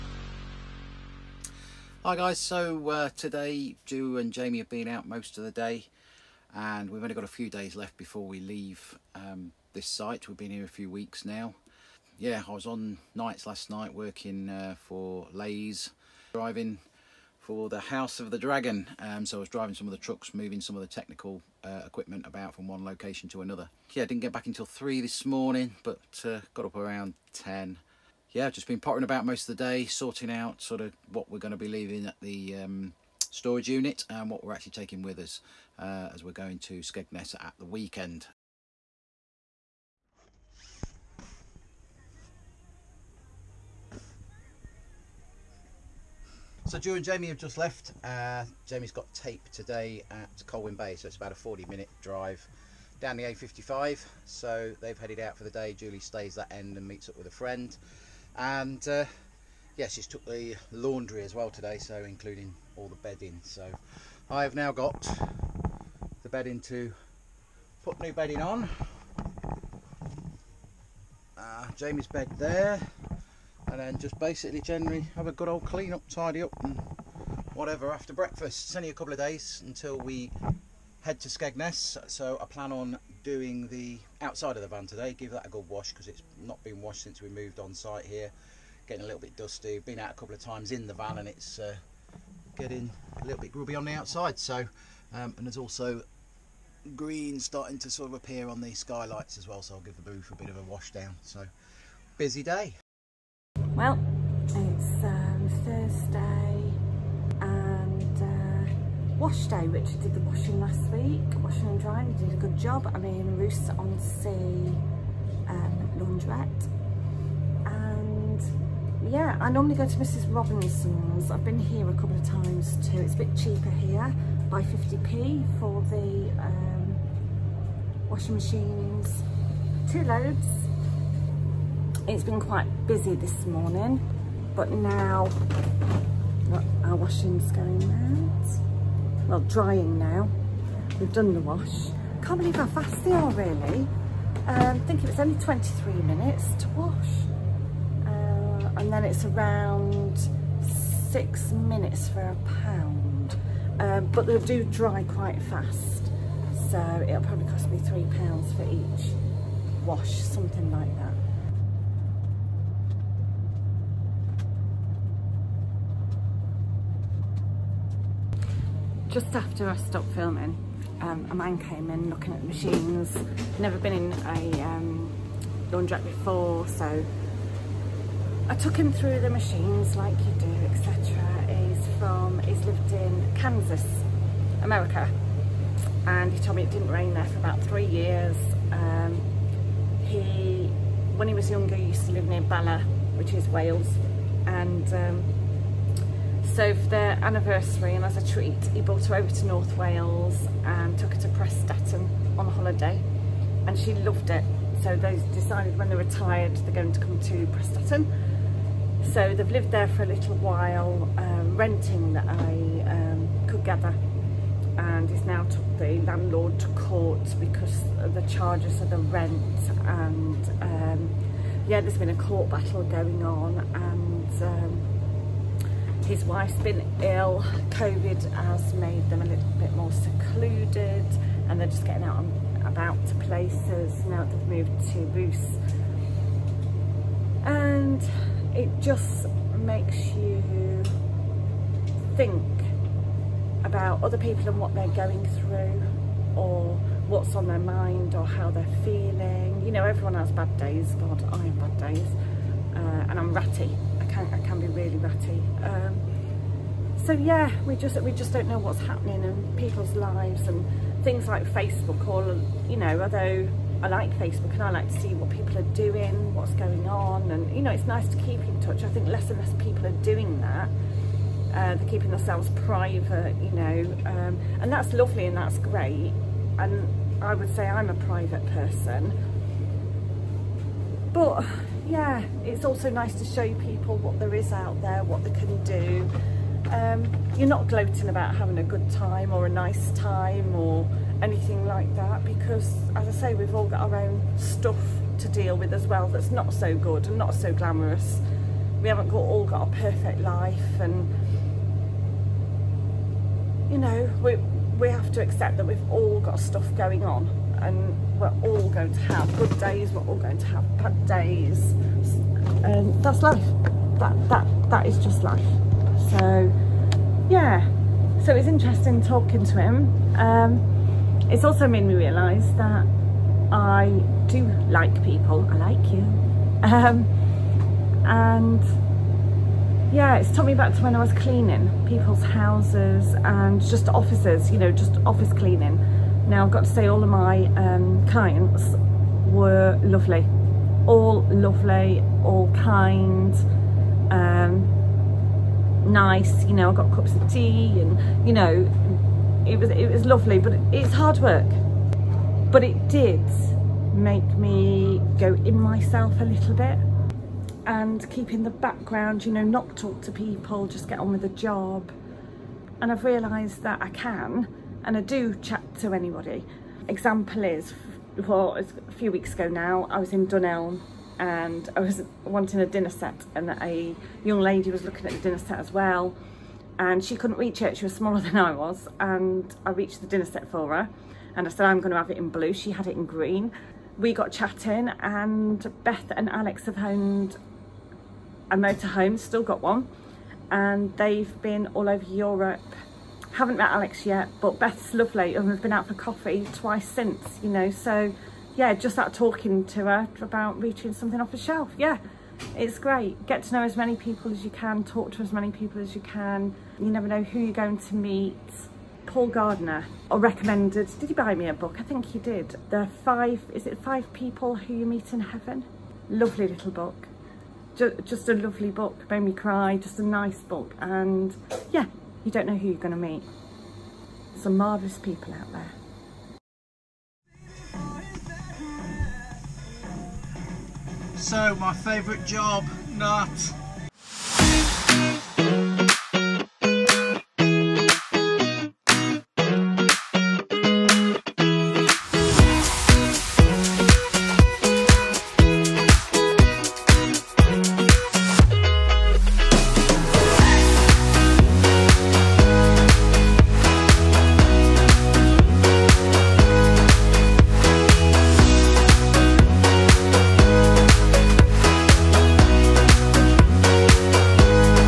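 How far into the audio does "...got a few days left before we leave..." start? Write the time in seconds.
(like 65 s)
7 s.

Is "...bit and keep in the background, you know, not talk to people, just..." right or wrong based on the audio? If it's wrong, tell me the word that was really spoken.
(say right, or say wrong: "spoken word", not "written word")
right.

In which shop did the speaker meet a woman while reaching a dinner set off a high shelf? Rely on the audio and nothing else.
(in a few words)
Dunelm.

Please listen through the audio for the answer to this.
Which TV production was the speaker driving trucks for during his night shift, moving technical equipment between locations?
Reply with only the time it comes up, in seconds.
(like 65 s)
17 s.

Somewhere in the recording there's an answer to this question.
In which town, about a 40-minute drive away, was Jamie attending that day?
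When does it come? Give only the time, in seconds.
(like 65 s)
50 s.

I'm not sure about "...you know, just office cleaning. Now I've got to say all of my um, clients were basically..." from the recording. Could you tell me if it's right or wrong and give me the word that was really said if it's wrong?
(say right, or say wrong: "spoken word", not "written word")
wrong: "lovely", not "basically".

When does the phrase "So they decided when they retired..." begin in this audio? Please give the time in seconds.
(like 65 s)
204 s.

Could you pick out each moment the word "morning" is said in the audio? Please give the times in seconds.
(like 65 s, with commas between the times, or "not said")
25 s, 133 s.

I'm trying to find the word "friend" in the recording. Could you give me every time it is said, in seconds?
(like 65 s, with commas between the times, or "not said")
57 s.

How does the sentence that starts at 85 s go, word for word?
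Give that a good wash because it's not been washed since we moved on site here.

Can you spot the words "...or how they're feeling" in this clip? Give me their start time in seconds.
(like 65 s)
248 s.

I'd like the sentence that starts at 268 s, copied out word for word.
I think less and less people are doing that.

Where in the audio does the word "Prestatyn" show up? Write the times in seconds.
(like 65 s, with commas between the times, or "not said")
201 s, 207 s.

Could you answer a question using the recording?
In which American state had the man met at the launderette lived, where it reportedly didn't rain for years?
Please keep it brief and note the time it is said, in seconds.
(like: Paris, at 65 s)
Kansas, at 183 s.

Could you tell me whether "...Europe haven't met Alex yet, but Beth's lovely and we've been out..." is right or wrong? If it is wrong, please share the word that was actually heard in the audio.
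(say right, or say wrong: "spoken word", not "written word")
right.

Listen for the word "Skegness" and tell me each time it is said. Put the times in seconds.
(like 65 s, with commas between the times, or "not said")
36 s, 81 s.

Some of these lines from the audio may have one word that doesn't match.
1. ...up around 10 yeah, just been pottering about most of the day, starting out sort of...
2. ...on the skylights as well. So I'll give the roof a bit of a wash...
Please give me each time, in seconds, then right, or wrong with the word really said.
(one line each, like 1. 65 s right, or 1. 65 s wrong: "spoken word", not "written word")
1. 26 s wrong: "sorting", not "starting"
2. 98 s right.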